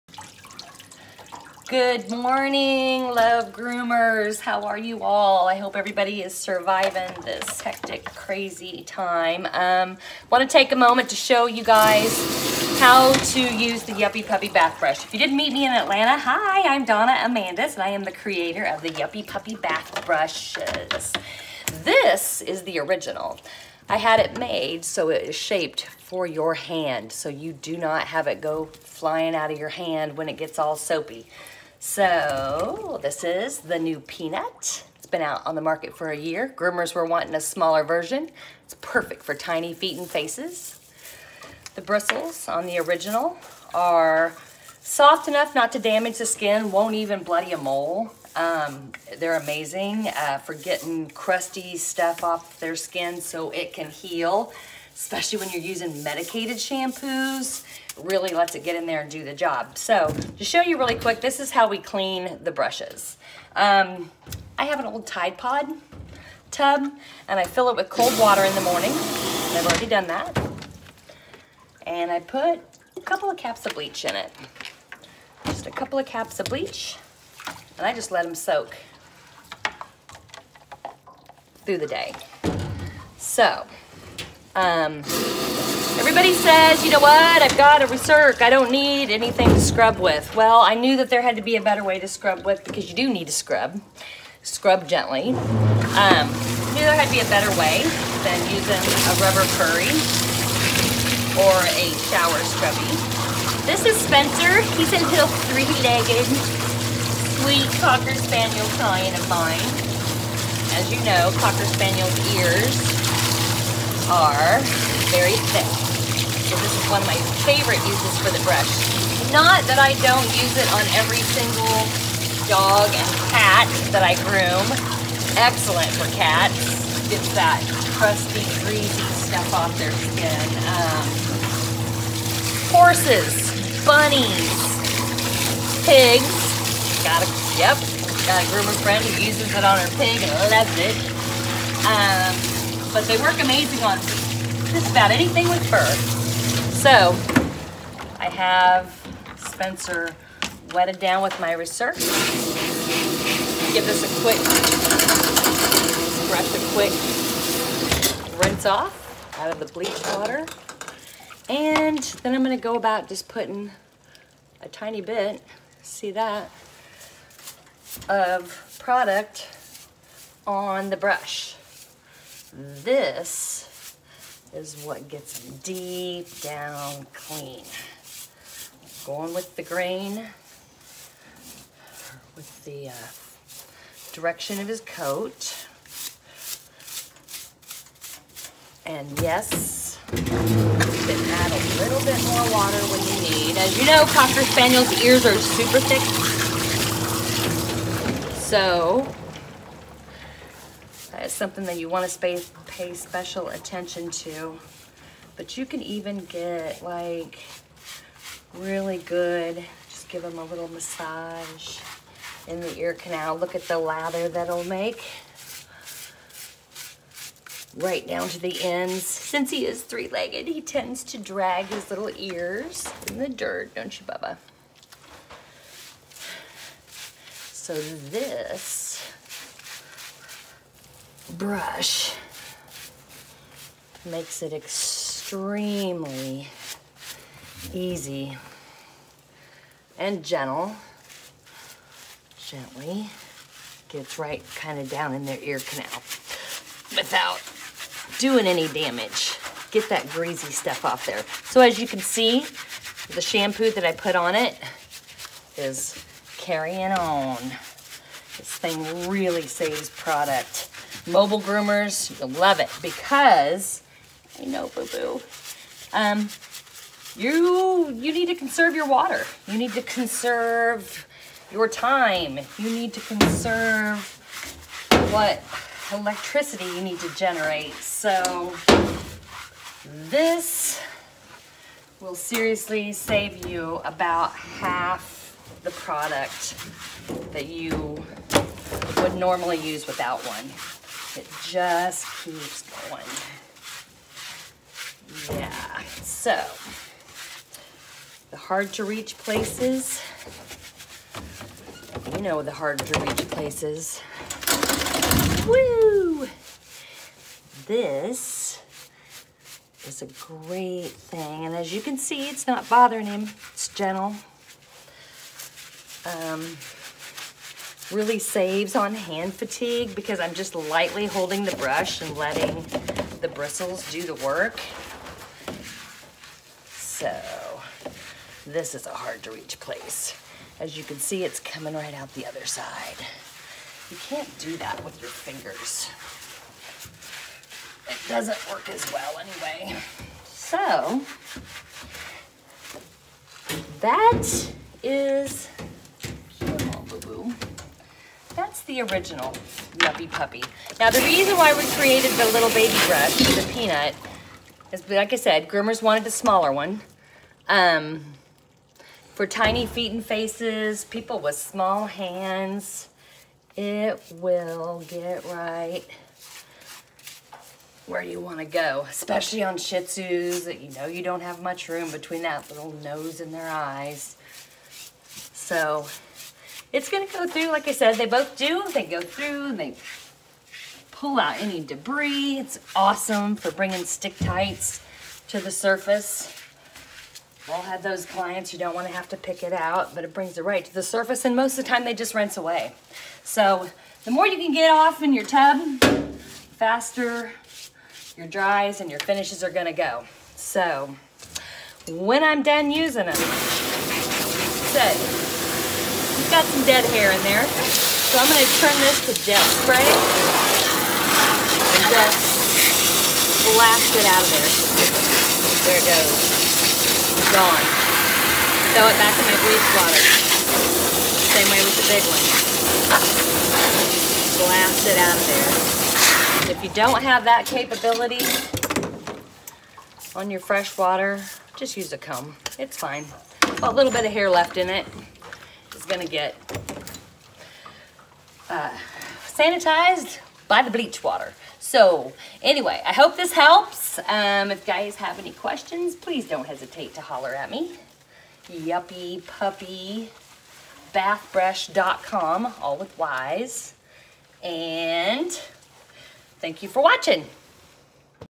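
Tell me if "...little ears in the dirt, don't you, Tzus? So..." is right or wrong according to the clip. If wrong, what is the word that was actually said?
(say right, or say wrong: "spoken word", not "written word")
wrong: "Bubba", not "Tzus".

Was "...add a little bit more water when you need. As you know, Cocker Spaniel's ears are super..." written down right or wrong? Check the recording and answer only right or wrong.
right.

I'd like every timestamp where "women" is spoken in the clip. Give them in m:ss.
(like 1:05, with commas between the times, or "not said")
not said.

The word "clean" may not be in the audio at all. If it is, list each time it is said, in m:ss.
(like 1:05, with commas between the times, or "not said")
1:01, 2:57.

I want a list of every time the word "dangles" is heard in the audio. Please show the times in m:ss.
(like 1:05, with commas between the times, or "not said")
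not said.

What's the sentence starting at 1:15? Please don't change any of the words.
Just a couple of caps of bleach and I just let them soak through the day.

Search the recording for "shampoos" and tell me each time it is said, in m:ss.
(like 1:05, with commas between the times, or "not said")
0:56, 4:13.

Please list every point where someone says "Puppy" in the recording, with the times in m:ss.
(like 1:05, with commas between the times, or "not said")
0:14, 0:19, 5:50, 7:29.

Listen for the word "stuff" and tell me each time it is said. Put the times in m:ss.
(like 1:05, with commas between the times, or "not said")
0:51, 2:09, 4:10.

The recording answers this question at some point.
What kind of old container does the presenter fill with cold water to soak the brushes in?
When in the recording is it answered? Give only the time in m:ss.
1:05.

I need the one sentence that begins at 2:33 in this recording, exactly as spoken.
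Give this a quick brush, a quick rinse off out of the bleach water.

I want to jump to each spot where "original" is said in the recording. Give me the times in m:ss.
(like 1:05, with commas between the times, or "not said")
0:22, 0:42, 5:48.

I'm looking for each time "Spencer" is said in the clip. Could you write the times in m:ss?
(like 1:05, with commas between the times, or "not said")
1:44, 2:29.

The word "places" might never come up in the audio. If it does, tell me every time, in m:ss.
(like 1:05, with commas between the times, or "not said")
4:59, 5:03, 5:29.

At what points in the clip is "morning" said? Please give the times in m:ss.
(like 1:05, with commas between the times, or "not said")
0:02, 1:08.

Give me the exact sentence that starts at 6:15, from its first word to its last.
So it's going to go through, like I said, they both do.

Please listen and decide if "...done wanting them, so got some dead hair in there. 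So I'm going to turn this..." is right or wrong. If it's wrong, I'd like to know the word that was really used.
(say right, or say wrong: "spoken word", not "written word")
wrong: "using", not "wanting".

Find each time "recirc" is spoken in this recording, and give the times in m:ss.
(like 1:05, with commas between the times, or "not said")
1:27, 2:31.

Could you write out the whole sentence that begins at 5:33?
You can't do that with your fingers.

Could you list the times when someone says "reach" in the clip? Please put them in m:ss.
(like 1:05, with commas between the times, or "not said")
4:58, 5:03, 5:29.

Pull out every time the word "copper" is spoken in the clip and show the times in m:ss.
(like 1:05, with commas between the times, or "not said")
not said.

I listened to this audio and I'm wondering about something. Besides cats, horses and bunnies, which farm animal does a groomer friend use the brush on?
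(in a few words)
Pig.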